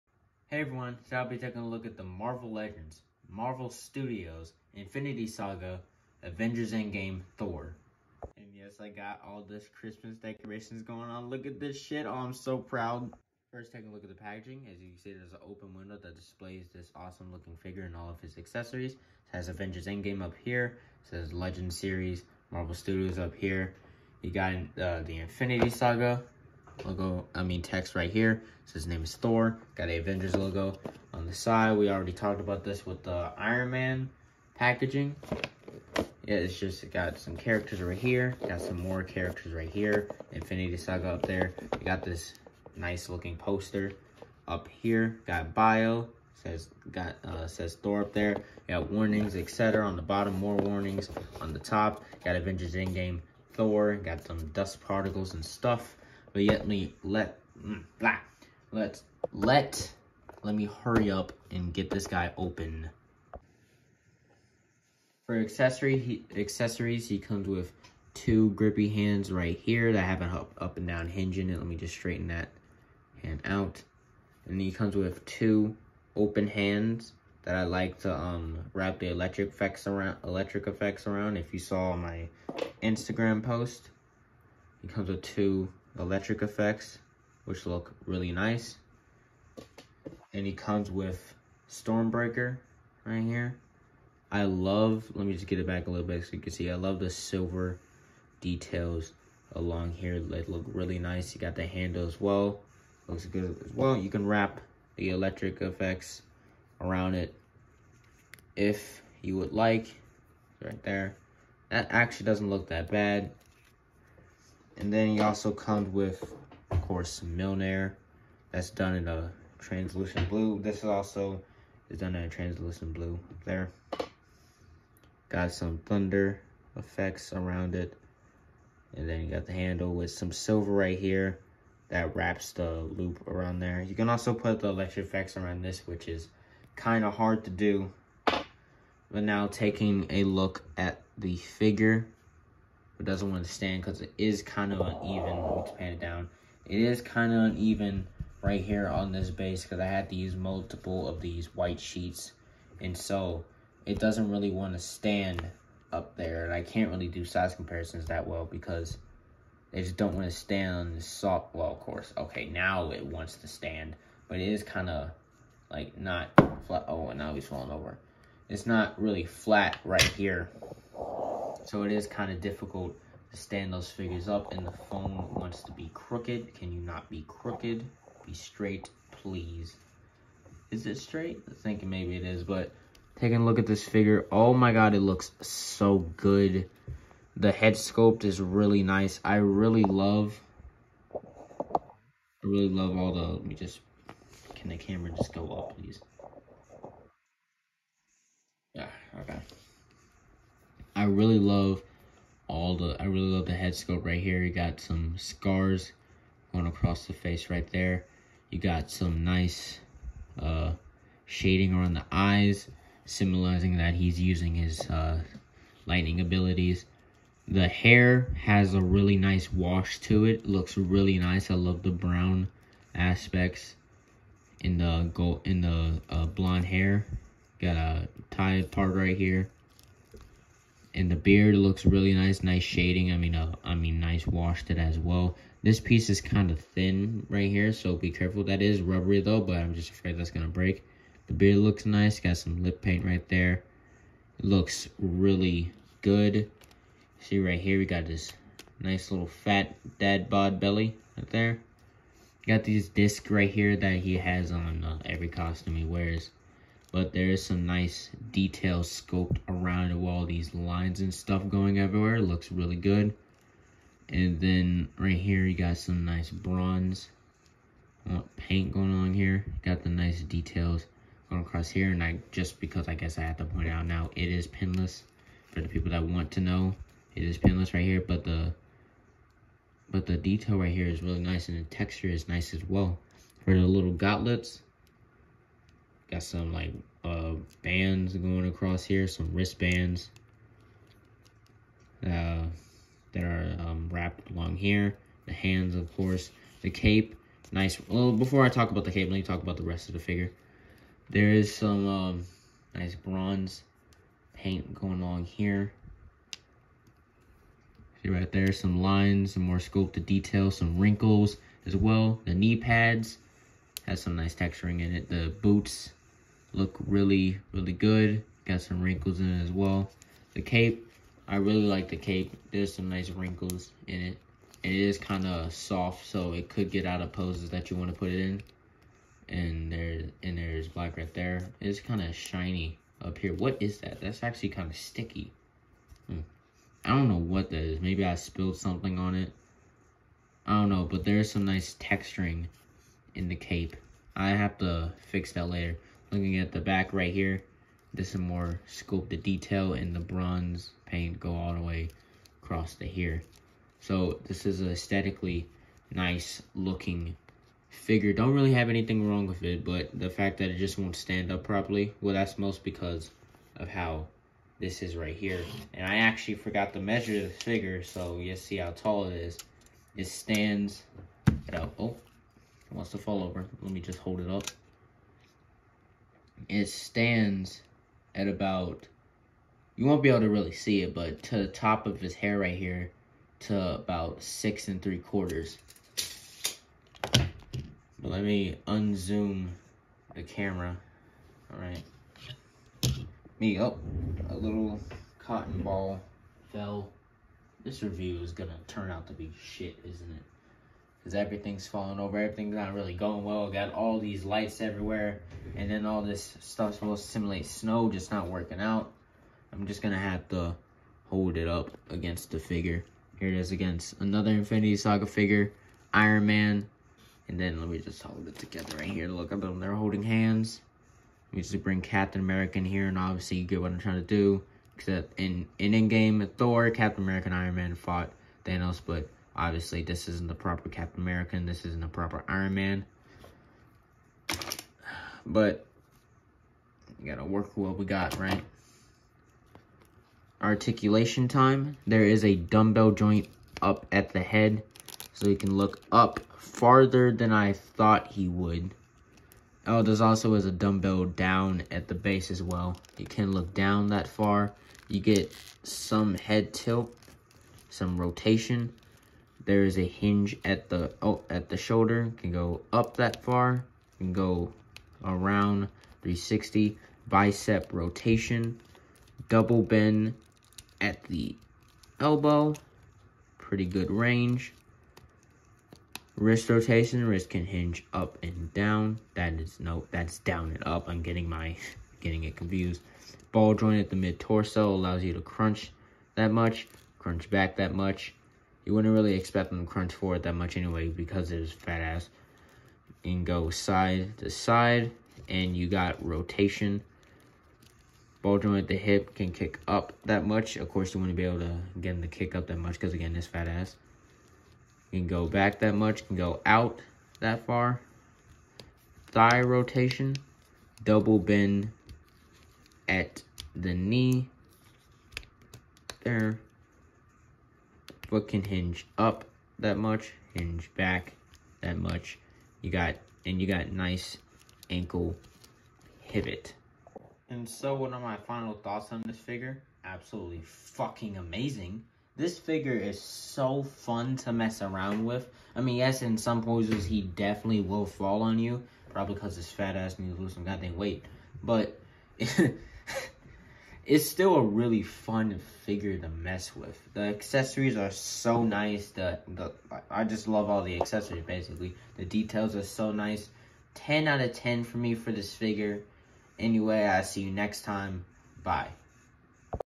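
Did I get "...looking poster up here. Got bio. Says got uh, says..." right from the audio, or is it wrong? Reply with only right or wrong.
right.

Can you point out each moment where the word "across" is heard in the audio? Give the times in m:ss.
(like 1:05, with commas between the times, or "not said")
3:26, 4:31, 4:48, 5:52.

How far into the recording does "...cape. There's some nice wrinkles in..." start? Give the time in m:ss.
5:21.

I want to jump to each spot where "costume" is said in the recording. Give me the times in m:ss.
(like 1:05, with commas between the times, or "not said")
4:15.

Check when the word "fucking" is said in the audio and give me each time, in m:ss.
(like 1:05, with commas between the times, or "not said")
8:50.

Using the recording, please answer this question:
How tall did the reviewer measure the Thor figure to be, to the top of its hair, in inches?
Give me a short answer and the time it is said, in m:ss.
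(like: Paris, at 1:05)
6 3/4, at 6:24.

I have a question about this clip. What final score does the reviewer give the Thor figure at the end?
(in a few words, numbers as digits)
10 out of 10.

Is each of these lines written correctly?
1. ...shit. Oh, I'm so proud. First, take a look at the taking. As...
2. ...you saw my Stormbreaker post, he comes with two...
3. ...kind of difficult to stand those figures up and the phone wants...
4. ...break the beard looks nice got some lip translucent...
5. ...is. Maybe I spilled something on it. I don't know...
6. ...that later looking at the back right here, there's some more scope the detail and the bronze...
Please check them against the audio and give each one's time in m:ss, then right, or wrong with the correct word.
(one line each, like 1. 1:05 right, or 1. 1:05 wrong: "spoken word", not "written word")
1. 0:11 wrong: "packaging", not "taking"
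2. 1:21 wrong: "Instagram", not "Stormbreaker"
3. 2:52 right
4. 4:00 wrong: "paint", not "translucent"
5. 5:37 right
6. 5:45 right.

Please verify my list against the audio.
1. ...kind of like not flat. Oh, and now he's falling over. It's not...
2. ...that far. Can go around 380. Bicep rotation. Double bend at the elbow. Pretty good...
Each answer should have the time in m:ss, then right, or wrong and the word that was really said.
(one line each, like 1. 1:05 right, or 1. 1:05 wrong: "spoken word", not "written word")
1. 2:44 right
2. 7:42 wrong: "360", not "380".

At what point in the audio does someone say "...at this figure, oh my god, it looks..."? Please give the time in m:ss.
3:03.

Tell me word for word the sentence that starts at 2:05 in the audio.
Got some thunder effects around it.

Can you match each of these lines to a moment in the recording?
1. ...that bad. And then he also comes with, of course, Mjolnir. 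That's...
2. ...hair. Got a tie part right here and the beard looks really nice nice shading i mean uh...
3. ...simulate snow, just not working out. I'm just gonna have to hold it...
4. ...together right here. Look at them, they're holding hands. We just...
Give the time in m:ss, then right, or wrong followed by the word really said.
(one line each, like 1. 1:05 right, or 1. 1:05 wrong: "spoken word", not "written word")
1. 1:52 right
2. 3:46 right
3. 6:47 right
4. 6:58 right.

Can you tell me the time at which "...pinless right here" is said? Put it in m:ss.
4:37.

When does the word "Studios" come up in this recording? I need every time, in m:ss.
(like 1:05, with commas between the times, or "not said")
0:03, 0:22.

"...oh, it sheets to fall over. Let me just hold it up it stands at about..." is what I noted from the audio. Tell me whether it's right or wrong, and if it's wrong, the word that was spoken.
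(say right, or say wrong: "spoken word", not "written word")
wrong: "wants", not "sheets".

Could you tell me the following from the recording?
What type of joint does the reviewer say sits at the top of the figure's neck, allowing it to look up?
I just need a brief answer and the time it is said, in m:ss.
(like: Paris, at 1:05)
dumbbell joint, at 7:22.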